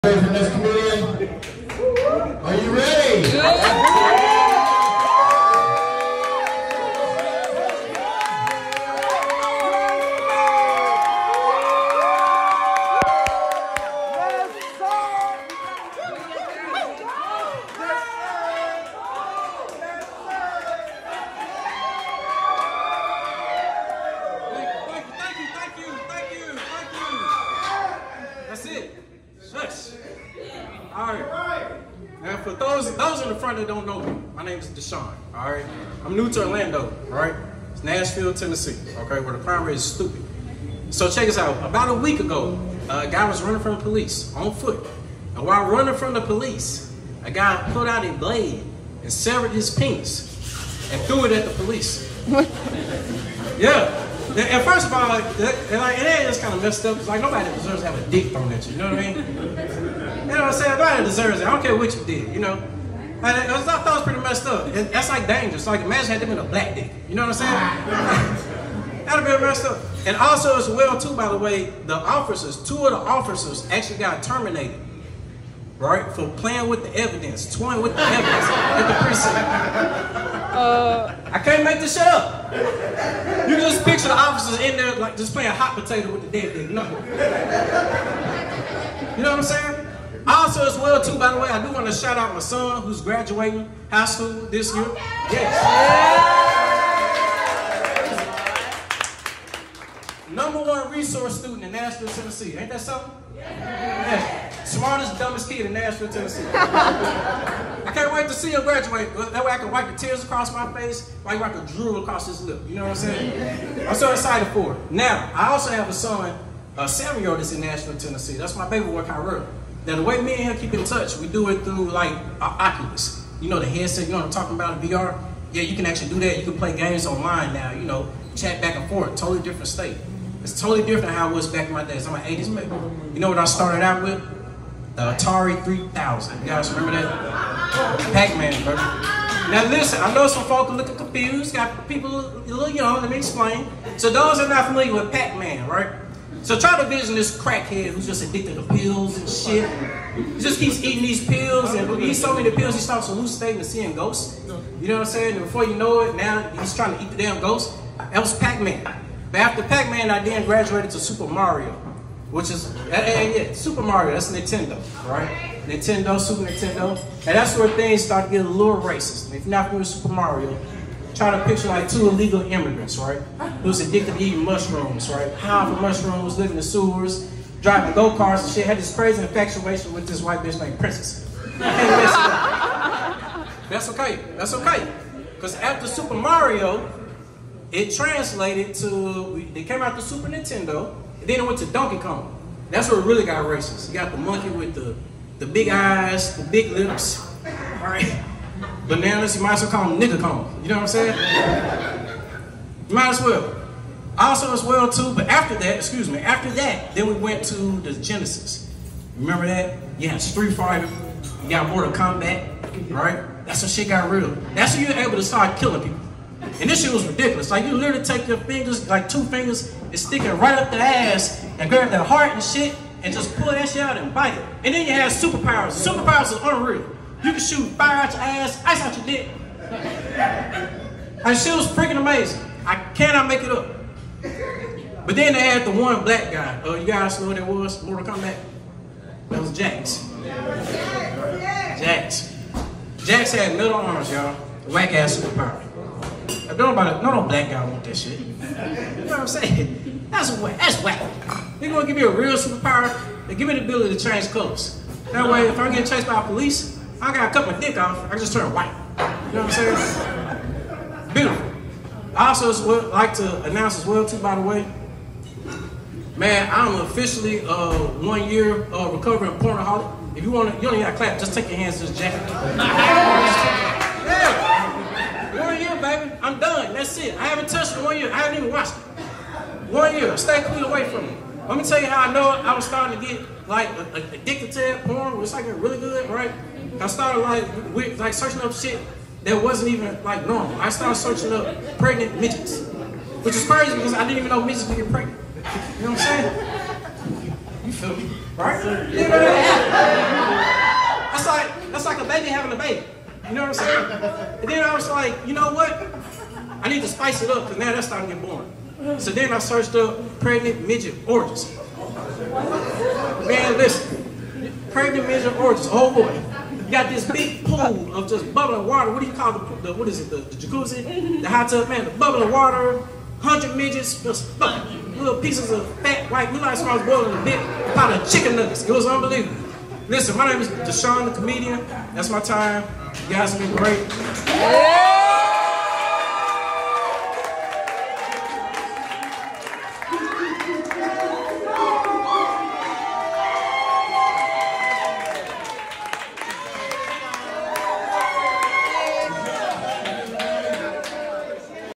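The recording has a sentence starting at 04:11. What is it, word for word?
They're gonna give me a real superpower.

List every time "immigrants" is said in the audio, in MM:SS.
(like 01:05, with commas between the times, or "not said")
02:52.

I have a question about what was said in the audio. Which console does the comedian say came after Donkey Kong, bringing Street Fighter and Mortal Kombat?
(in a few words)
Genesis.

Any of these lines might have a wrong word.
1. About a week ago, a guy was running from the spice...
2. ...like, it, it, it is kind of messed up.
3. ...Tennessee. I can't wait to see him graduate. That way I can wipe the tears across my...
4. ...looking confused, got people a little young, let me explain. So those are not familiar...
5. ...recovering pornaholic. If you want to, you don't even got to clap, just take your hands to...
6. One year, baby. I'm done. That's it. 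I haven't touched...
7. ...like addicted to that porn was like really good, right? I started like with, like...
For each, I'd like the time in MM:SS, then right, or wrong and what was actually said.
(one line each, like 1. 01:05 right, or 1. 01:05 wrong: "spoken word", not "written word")
1. 00:41 wrong: "police", not "spice"
2. 00:55 right
3. 01:46 right
4. 02:20 right
5. 04:28 right
6. 04:35 right
7. 04:43 right.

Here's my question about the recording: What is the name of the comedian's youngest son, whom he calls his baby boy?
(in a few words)
Kyrell.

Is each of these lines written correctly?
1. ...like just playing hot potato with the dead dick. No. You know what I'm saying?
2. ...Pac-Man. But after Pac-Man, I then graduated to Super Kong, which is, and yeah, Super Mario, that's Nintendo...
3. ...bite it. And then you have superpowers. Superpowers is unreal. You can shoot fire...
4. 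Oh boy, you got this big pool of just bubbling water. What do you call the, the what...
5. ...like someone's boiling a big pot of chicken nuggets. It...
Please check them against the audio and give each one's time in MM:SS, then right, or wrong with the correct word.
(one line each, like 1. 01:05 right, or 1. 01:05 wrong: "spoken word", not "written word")
1. 01:24 right
2. 02:38 wrong: "Mario", not "Kong"
3. 03:44 right
4. 05:15 right
5. 05:26 right.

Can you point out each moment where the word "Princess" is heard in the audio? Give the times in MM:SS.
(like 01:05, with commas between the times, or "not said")
03:00.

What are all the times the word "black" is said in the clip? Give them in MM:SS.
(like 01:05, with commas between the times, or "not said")
01:06, 03:56, 04:07.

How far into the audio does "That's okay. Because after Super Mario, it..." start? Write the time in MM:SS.
03:04.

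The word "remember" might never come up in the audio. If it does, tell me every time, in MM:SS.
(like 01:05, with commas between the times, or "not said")
02:16, 03:29.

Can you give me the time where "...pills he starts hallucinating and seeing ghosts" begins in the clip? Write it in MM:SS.
02:32.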